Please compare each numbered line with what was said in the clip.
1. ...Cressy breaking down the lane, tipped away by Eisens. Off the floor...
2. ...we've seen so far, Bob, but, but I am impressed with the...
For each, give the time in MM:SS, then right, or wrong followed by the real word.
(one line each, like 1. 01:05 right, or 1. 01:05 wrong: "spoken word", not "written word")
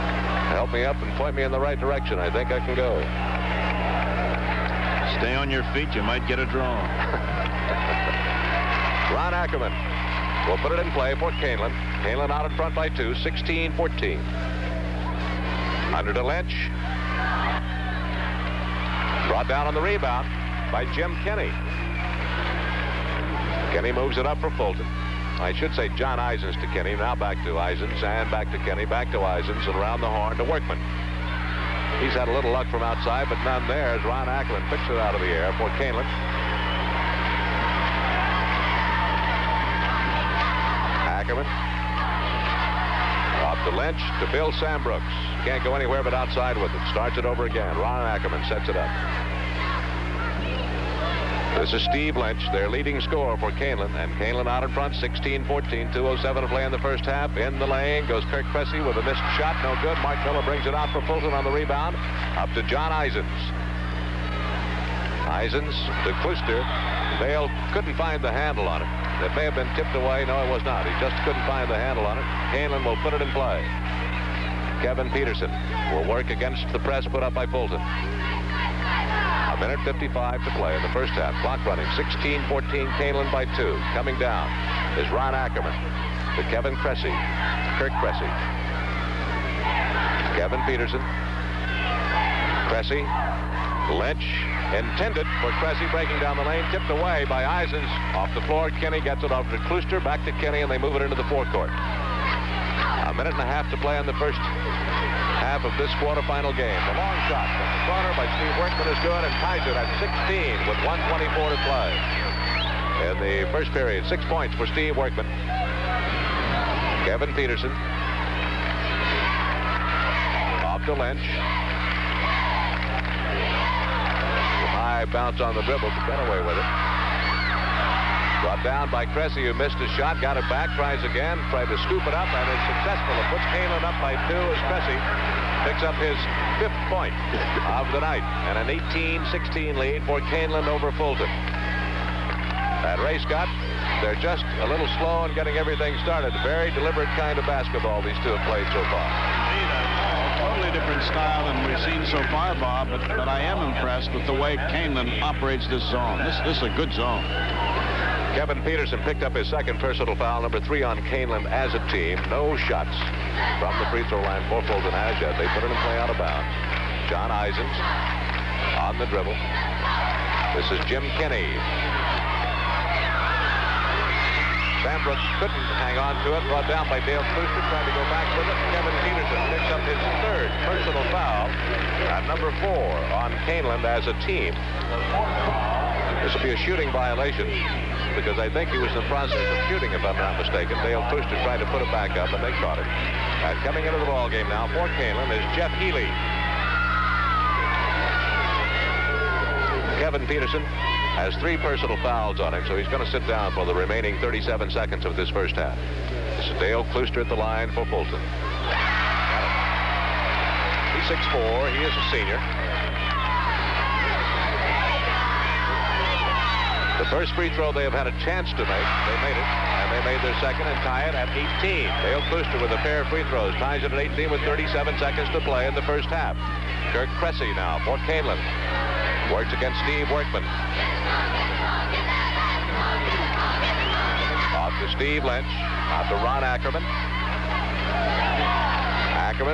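1. 01:35 right
2. 02:31 right.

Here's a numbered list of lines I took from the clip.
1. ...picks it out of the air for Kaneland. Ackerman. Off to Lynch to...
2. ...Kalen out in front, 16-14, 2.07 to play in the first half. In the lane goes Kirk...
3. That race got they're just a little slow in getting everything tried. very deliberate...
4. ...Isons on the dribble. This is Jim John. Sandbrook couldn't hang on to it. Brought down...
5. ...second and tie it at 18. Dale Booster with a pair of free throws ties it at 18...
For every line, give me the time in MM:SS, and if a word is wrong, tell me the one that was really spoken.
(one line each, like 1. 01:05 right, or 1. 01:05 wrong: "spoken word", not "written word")
1. 00:34 right
2. 00:54 right
3. 02:22 wrong: "started", not "tried"
4. 02:47 wrong: "Kinney", not "John"
5. 03:40 right.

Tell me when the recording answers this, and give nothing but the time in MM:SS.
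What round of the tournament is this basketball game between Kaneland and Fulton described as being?
01:45.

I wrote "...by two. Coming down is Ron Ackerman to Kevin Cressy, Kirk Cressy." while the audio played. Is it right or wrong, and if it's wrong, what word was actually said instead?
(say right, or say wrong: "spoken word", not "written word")
right.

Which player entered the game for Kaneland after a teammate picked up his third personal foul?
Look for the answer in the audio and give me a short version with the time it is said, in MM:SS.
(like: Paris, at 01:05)
Jeff Healy, at 03:15.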